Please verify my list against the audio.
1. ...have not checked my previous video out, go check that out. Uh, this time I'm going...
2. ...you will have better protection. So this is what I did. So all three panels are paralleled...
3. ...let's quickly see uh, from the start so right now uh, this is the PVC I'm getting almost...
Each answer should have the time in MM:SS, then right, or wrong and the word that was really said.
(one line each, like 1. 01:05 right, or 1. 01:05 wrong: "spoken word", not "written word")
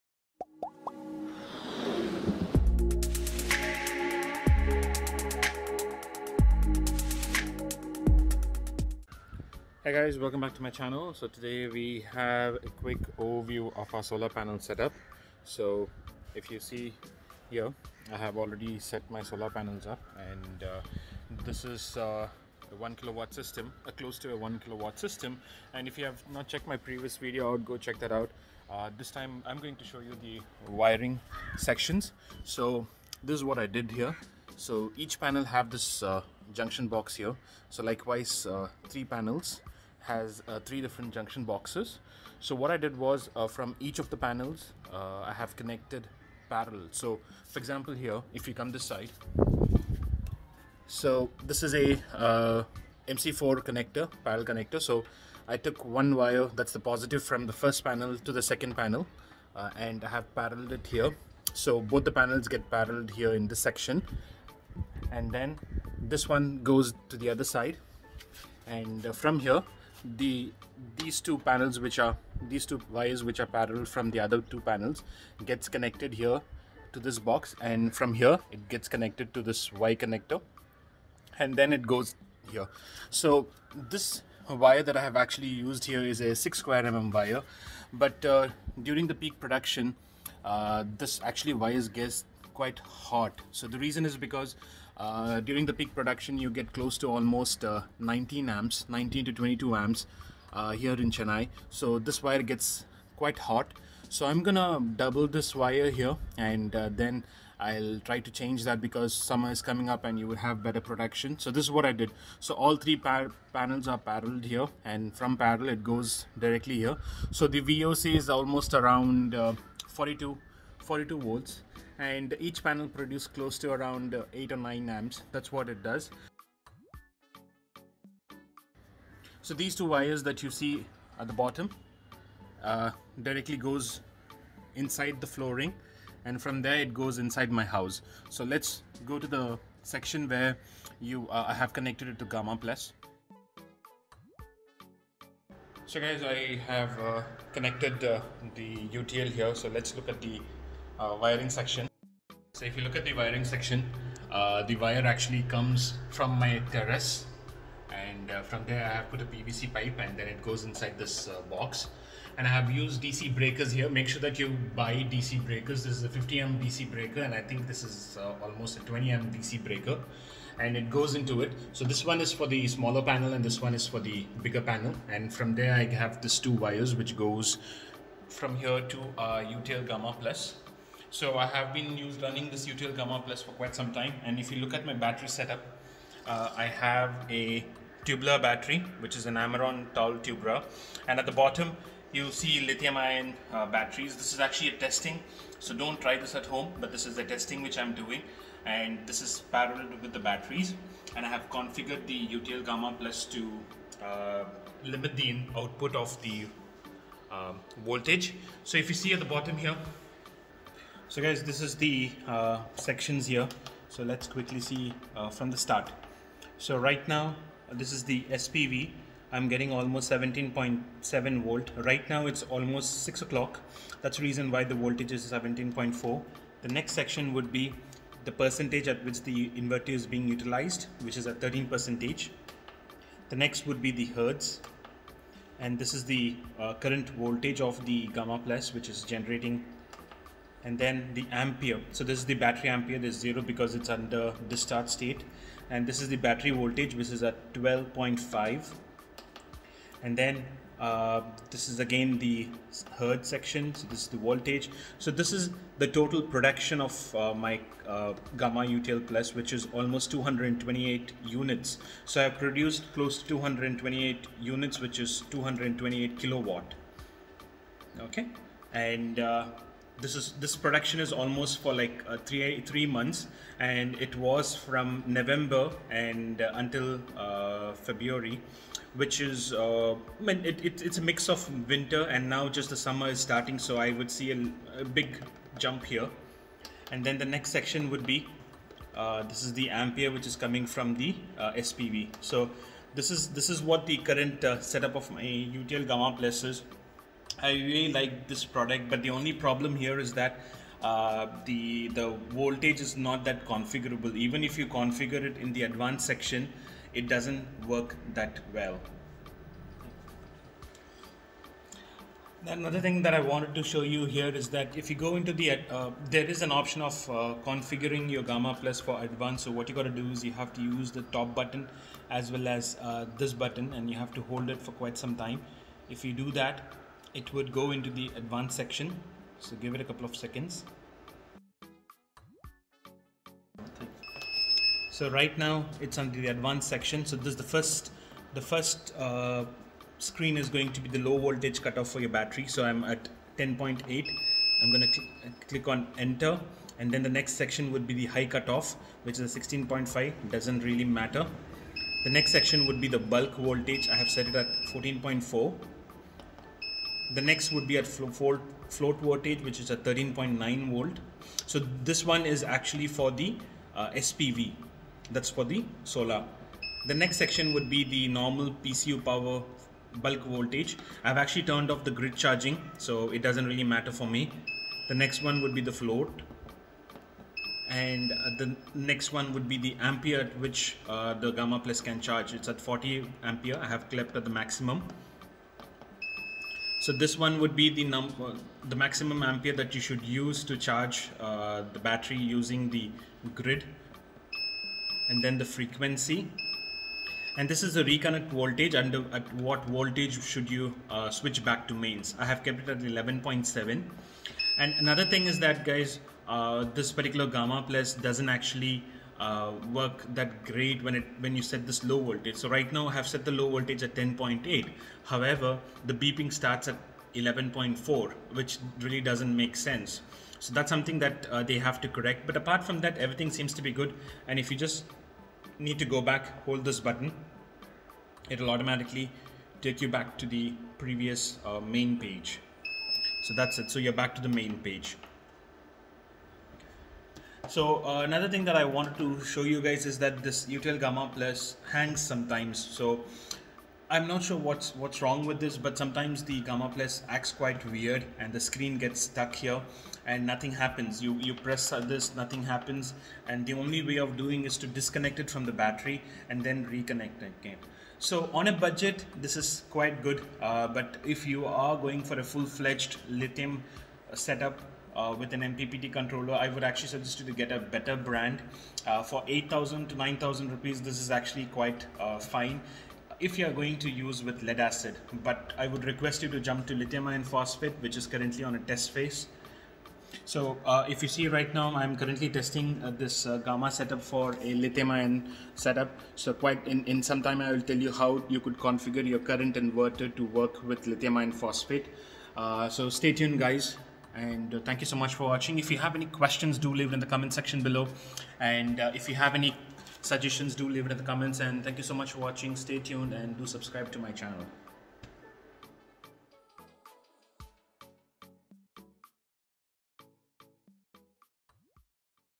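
1. 00:26 right
2. 01:50 right
3. 03:34 wrong: "SPV", not "PVC".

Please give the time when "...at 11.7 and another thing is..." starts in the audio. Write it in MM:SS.
06:42.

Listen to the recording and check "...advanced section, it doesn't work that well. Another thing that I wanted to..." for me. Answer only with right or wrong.
right.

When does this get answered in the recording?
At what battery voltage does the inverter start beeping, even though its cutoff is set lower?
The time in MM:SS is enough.
06:57.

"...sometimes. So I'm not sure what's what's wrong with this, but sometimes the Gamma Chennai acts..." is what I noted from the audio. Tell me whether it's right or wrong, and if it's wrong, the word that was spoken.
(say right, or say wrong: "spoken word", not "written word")
wrong: "Plus", not "Chennai".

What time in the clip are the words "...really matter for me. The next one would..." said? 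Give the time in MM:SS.
06:13.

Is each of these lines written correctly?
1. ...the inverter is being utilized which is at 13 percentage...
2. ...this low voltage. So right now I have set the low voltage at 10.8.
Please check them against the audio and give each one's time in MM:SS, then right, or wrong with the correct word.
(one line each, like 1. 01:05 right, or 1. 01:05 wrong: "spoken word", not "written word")
1. 03:49 right
2. 06:51 right.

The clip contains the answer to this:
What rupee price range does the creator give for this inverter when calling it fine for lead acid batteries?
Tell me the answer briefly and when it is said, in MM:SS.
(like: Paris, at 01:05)
8,000 to 9,000 rupees, at 07:49.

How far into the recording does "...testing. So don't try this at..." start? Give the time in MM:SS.
03:14.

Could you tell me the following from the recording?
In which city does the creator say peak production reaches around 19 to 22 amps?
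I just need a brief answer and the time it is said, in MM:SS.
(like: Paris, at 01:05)
Chennai, at 01:41.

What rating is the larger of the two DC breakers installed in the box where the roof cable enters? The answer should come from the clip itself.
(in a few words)
50 amp.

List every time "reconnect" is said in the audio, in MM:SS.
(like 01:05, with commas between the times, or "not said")
06:37, 07:36.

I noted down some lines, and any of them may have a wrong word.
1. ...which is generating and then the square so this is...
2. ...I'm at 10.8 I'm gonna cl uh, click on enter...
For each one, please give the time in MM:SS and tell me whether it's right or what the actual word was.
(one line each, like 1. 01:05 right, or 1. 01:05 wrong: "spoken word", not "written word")
1. 03:58 wrong: "ampere", not "square"
2. 05:42 right.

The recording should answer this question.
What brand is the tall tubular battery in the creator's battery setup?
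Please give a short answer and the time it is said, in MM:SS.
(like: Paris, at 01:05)
Amaron, at 03:09.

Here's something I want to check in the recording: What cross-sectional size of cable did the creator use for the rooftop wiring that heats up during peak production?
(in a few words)
6 square mm.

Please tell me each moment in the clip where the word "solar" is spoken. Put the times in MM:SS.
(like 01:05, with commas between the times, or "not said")
00:14, 00:19, 06:05.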